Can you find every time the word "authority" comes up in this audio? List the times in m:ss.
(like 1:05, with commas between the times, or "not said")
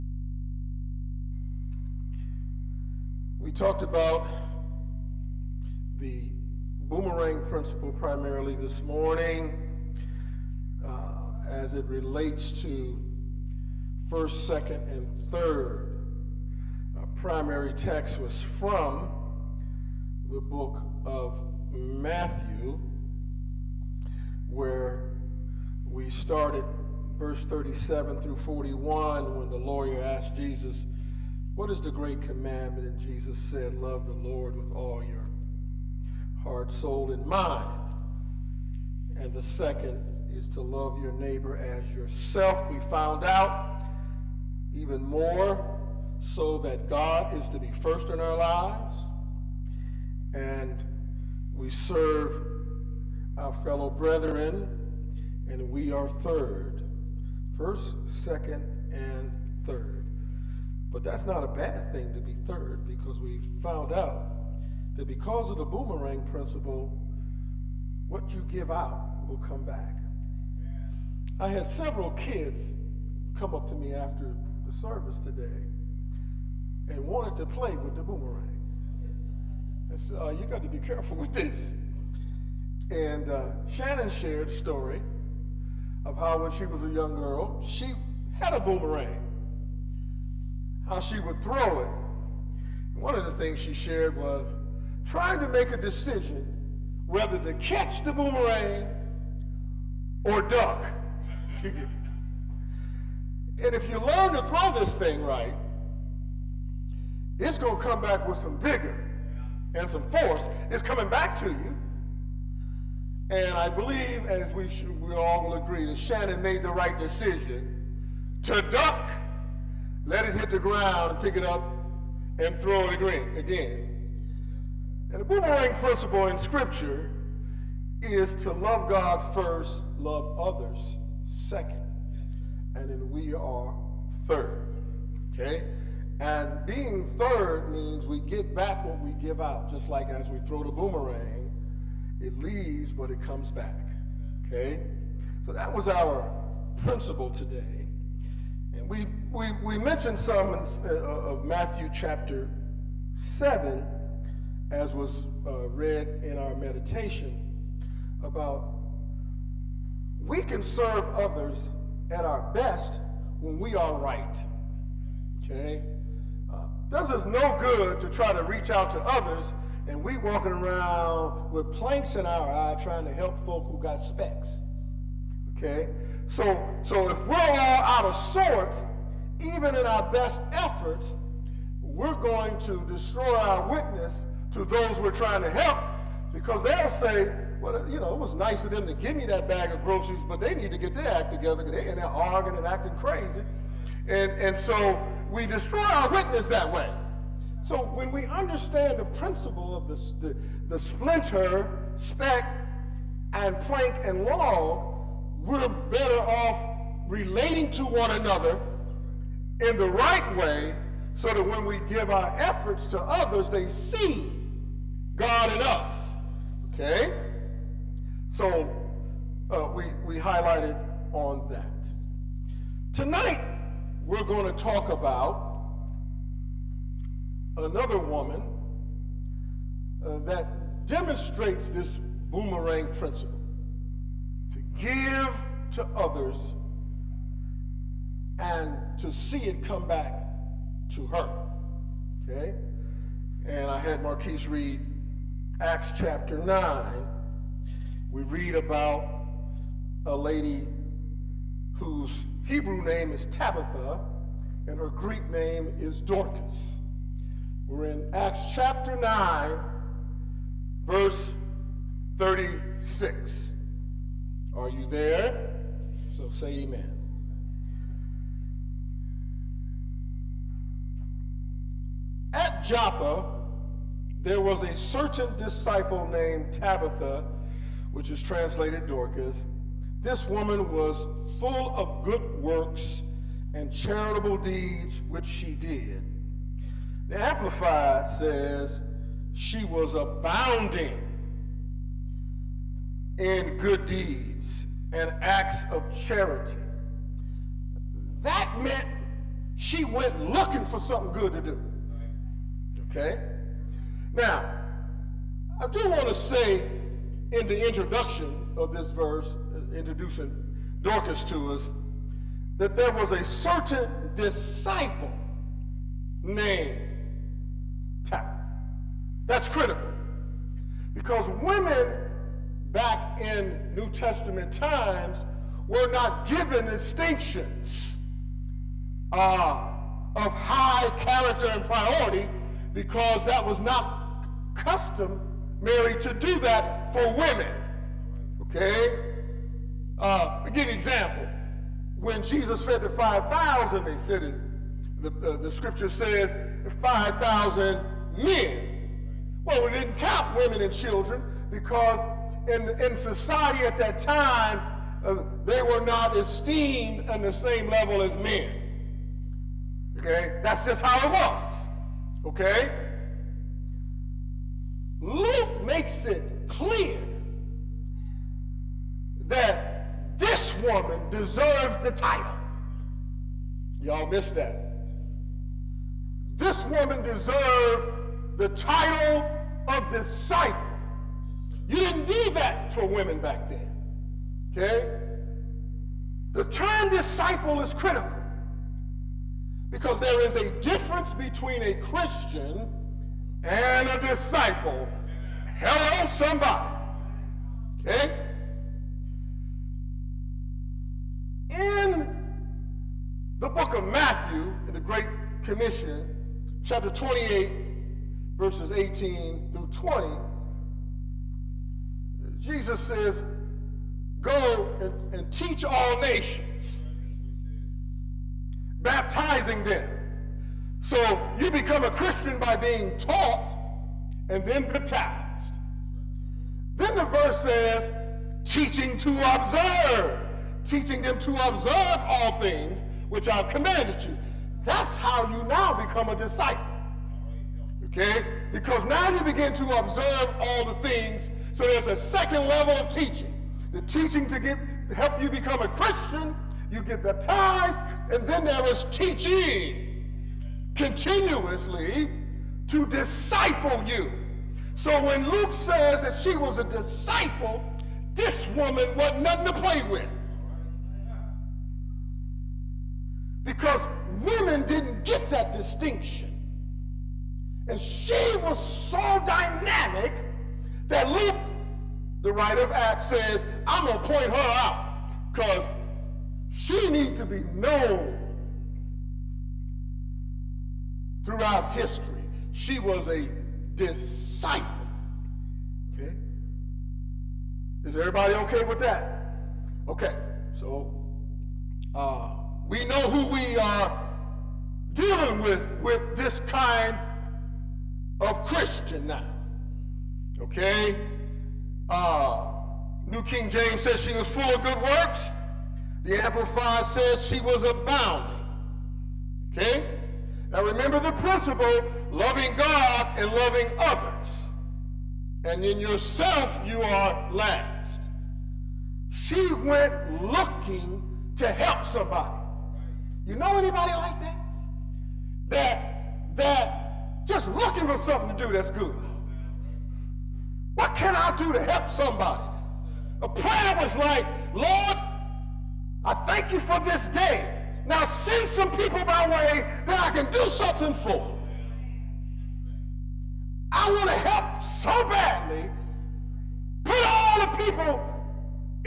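not said.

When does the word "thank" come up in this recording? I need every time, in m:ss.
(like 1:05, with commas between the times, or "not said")
8:56.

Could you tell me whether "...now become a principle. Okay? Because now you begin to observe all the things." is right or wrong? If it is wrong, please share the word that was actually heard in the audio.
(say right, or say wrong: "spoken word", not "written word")
wrong: "disciple", not "principle".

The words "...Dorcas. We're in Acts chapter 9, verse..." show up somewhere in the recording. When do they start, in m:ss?
4:16.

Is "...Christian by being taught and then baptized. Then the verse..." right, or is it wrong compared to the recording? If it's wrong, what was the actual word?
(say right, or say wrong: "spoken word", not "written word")
right.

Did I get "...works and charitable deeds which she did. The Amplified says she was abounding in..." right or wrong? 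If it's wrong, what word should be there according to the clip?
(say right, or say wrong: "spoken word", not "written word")
right.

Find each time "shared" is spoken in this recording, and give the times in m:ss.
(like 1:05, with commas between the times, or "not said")
1:24, 1:33.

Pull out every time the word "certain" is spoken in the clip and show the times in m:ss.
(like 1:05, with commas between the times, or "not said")
4:34, 5:13.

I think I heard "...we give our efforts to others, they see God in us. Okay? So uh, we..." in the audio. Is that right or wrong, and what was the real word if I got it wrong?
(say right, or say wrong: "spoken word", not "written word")
right.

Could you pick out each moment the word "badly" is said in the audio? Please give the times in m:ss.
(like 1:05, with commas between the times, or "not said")
9:05.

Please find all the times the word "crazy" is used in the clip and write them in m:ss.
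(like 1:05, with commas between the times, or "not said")
3:12.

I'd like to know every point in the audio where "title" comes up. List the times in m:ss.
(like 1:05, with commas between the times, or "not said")
6:11, 6:18.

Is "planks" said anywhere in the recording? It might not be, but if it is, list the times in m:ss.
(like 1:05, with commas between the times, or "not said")
2:51, 3:23.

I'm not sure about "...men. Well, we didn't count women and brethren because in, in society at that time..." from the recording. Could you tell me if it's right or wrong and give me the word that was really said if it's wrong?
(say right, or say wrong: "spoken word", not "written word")
wrong: "children", not "brethren".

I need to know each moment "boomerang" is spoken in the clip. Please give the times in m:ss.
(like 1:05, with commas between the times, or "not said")
0:06, 1:05, 1:18, 1:28, 1:38, 2:05, 2:20, 3:52.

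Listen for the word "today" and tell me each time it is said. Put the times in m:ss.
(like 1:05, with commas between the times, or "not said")
1:15, 2:27.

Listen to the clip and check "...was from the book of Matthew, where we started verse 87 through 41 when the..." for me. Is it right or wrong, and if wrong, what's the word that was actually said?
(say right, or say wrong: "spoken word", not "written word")
wrong: "37", not "87".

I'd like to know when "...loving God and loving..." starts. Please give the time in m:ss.
8:32.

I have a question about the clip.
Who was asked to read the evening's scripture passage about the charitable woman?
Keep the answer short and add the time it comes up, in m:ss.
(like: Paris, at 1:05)
Marquise, at 4:04.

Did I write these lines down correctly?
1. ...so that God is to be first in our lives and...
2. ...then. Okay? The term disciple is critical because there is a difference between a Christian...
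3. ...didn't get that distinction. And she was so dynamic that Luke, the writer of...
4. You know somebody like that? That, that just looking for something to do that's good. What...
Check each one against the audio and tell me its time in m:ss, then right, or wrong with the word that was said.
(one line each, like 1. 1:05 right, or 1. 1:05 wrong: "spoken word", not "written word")
1. 0:46 right
2. 6:23 right
3. 7:44 right
4. 8:43 wrong: "anybody", not "somebody".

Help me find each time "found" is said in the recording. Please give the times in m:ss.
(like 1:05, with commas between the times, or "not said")
0:42, 1:03.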